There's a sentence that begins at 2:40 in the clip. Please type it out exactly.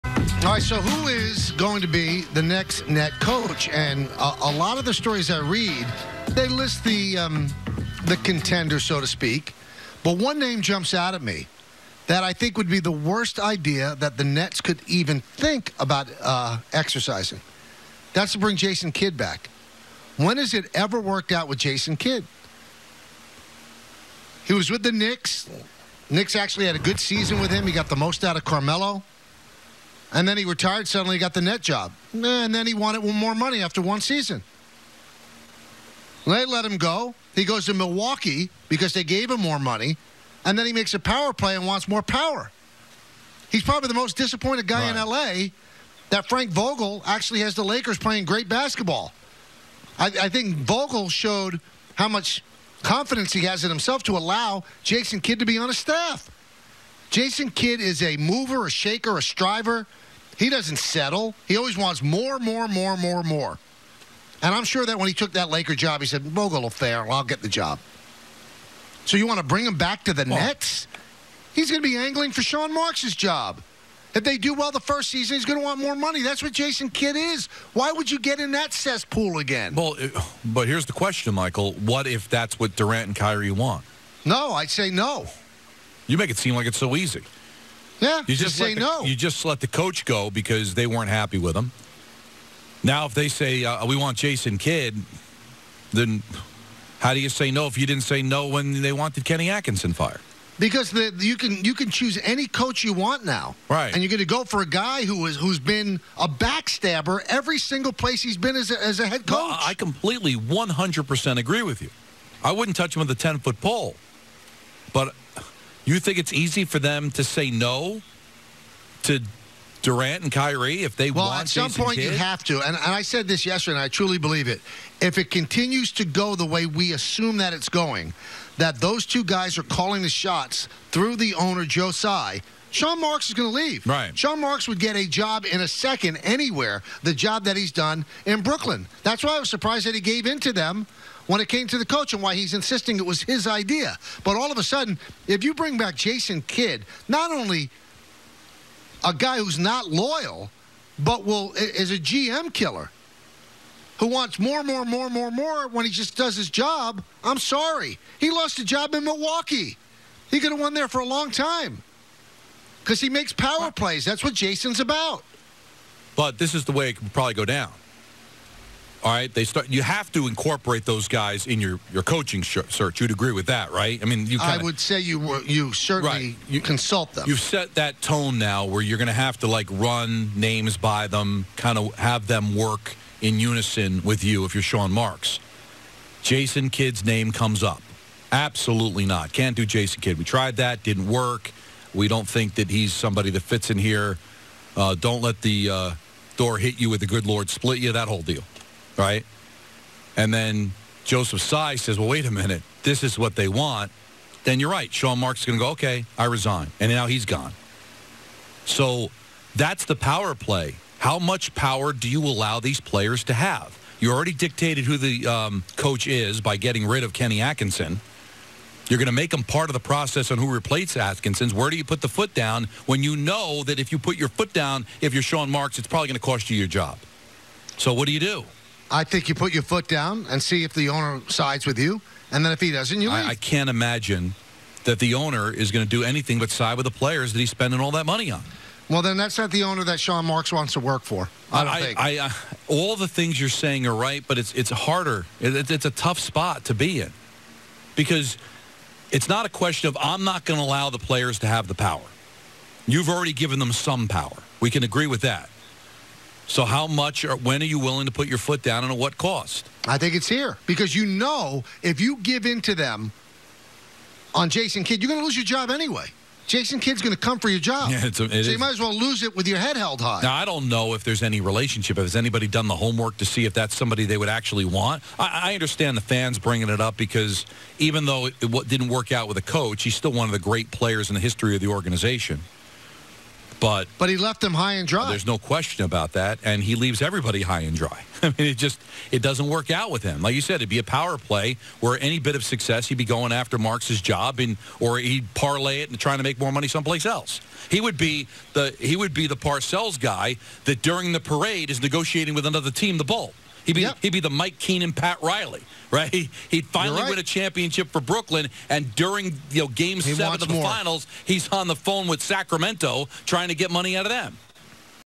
He could have won there for a long time because he makes power plays.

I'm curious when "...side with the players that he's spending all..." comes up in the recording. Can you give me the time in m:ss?
3:56.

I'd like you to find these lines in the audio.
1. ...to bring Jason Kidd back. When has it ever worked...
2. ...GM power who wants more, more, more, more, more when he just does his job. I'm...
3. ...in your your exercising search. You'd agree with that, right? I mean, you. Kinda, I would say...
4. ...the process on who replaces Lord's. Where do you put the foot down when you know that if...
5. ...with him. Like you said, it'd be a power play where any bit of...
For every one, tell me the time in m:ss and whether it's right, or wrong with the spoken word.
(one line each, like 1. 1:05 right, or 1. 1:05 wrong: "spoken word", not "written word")
1. 0:18 right
2. 2:31 wrong: "killer", not "power"
3. 2:51 wrong: "coaching", not "exercising"
4. 3:39 wrong: "Atkinson", not "Lord"
5. 4:49 right.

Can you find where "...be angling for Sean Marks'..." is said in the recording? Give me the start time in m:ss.
1:11.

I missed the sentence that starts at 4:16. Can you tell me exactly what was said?
So how much or when are you willing to put your foot down and at what cost?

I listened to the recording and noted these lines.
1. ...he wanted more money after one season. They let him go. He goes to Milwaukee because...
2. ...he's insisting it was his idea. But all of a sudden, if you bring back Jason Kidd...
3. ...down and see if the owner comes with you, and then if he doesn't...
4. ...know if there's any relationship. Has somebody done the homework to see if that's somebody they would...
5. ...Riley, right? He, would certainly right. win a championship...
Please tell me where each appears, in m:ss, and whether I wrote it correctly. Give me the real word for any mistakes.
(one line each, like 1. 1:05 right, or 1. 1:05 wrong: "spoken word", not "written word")
1. 0:32 right
2. 2:22 right
3. 3:49 wrong: "sides", not "comes"
4. 4:30 wrong: "anybody", not "somebody"
5. 5:05 wrong: "finally", not "certainly".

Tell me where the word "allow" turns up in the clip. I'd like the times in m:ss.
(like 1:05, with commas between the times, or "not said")
0:54, 3:32, 4:10.